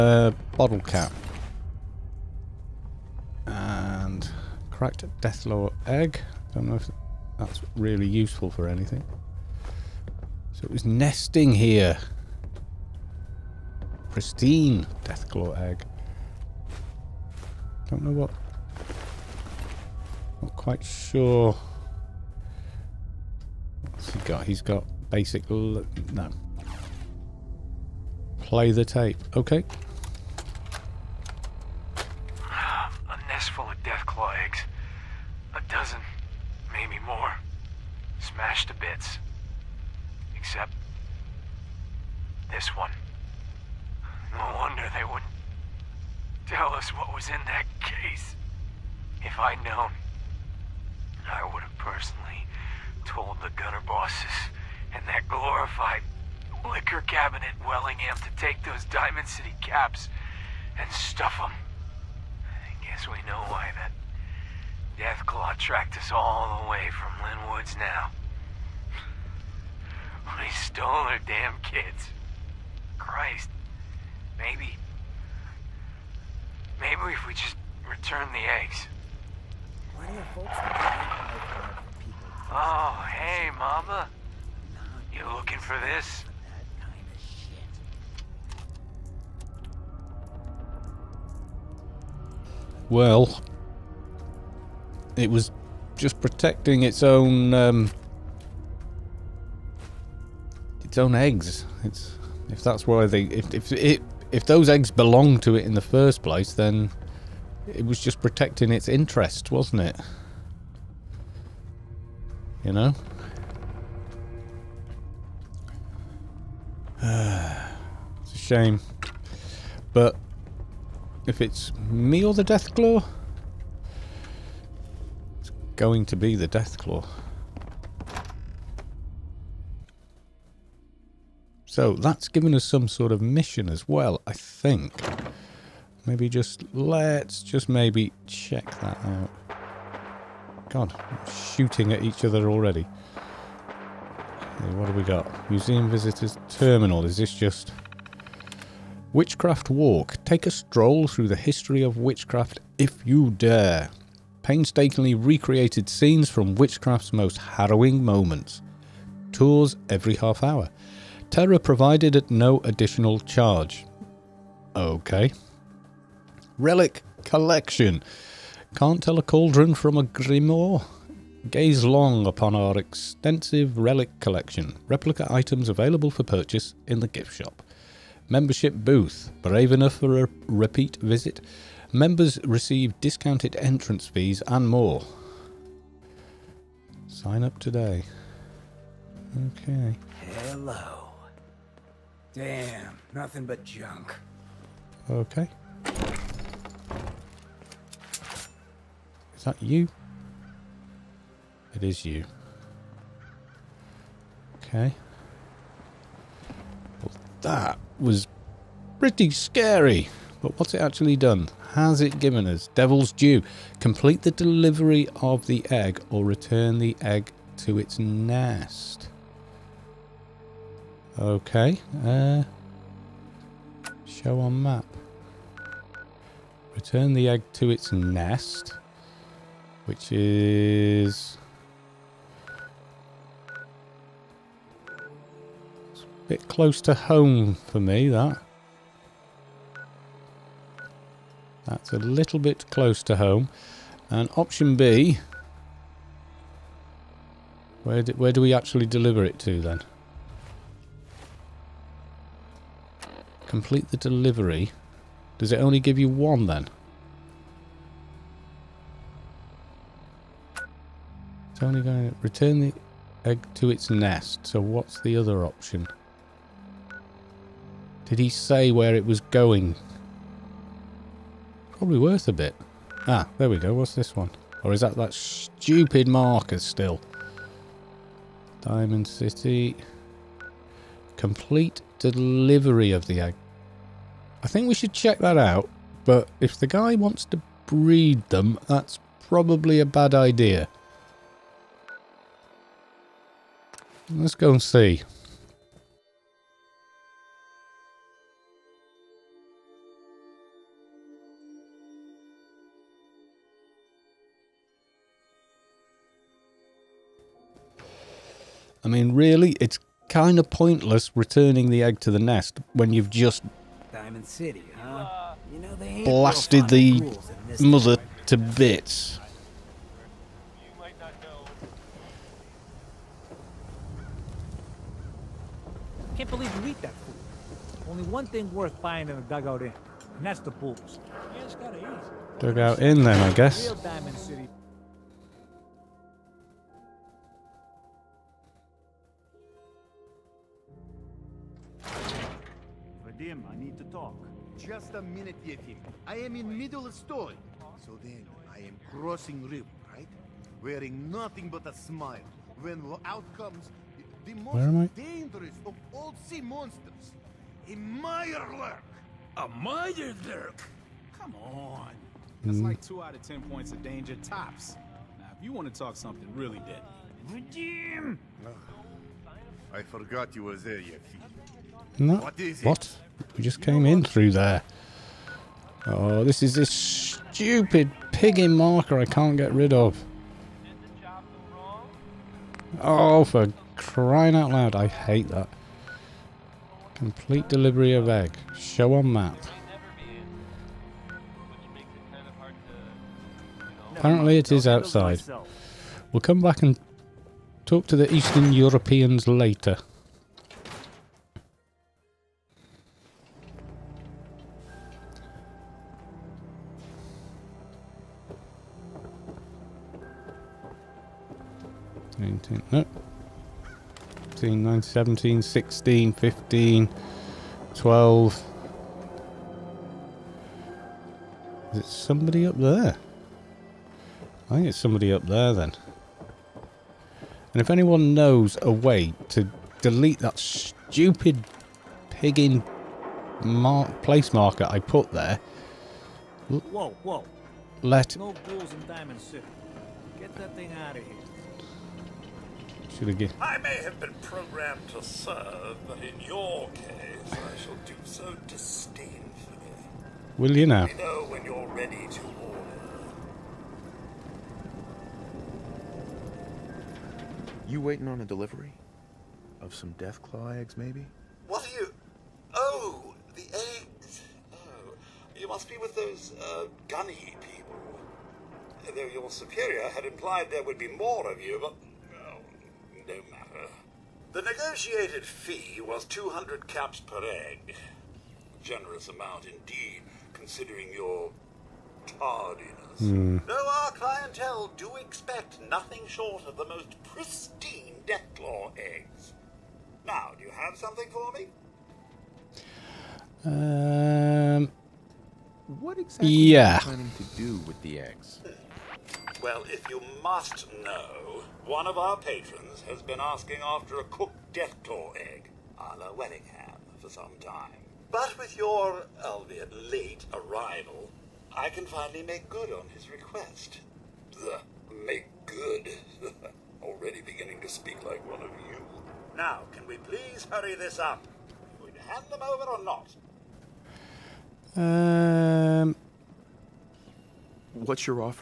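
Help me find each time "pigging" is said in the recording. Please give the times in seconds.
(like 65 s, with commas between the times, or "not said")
378 s, 432 s.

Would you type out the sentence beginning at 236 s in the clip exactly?
a bit close to home for me, that.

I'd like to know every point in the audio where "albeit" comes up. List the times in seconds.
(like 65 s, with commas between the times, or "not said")
509 s.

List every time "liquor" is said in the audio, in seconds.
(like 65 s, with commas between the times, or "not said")
56 s.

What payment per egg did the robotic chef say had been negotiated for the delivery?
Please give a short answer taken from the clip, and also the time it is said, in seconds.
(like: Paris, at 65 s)
200 caps, at 476 s.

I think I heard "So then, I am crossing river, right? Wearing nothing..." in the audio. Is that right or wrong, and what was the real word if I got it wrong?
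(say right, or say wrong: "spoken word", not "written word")
right.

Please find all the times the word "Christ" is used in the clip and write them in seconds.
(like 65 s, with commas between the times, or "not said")
72 s.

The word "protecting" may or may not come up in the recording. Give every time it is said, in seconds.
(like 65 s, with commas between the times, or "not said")
96 s, 108 s.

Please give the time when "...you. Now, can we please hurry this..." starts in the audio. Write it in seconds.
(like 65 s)
518 s.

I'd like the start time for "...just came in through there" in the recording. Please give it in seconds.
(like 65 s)
373 s.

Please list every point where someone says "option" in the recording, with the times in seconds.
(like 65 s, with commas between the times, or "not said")
244 s, 265 s.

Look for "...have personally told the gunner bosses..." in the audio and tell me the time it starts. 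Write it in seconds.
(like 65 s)
51 s.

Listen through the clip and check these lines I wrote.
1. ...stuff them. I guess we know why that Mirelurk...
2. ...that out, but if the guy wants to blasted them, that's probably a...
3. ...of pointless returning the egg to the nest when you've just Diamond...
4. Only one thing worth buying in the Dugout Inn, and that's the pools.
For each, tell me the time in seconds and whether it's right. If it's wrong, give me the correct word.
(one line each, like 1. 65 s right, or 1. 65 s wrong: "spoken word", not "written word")
1. 60 s wrong: "Deathclaw", not "Mirelurk"
2. 285 s wrong: "breed", not "blasted"
3. 310 s right
4. 327 s right.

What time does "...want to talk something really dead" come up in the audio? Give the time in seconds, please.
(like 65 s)
365 s.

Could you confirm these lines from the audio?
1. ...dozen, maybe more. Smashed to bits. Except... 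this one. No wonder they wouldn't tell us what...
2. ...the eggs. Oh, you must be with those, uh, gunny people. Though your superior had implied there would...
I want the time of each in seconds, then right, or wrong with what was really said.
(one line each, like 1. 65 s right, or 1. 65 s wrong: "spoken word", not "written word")
1. 35 s right
2. 463 s right.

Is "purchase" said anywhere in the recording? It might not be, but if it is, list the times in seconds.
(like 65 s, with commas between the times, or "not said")
176 s.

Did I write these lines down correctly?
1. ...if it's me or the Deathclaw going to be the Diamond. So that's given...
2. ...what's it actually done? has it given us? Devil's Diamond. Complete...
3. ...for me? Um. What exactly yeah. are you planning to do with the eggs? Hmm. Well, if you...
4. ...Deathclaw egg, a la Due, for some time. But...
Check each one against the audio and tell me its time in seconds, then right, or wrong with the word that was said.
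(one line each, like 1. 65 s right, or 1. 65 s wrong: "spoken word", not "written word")
1. 121 s wrong: "Deathclaw", not "Diamond"
2. 210 s wrong: "Due", not "Diamond"
3. 491 s right
4. 504 s wrong: "Wellingham", not "Due".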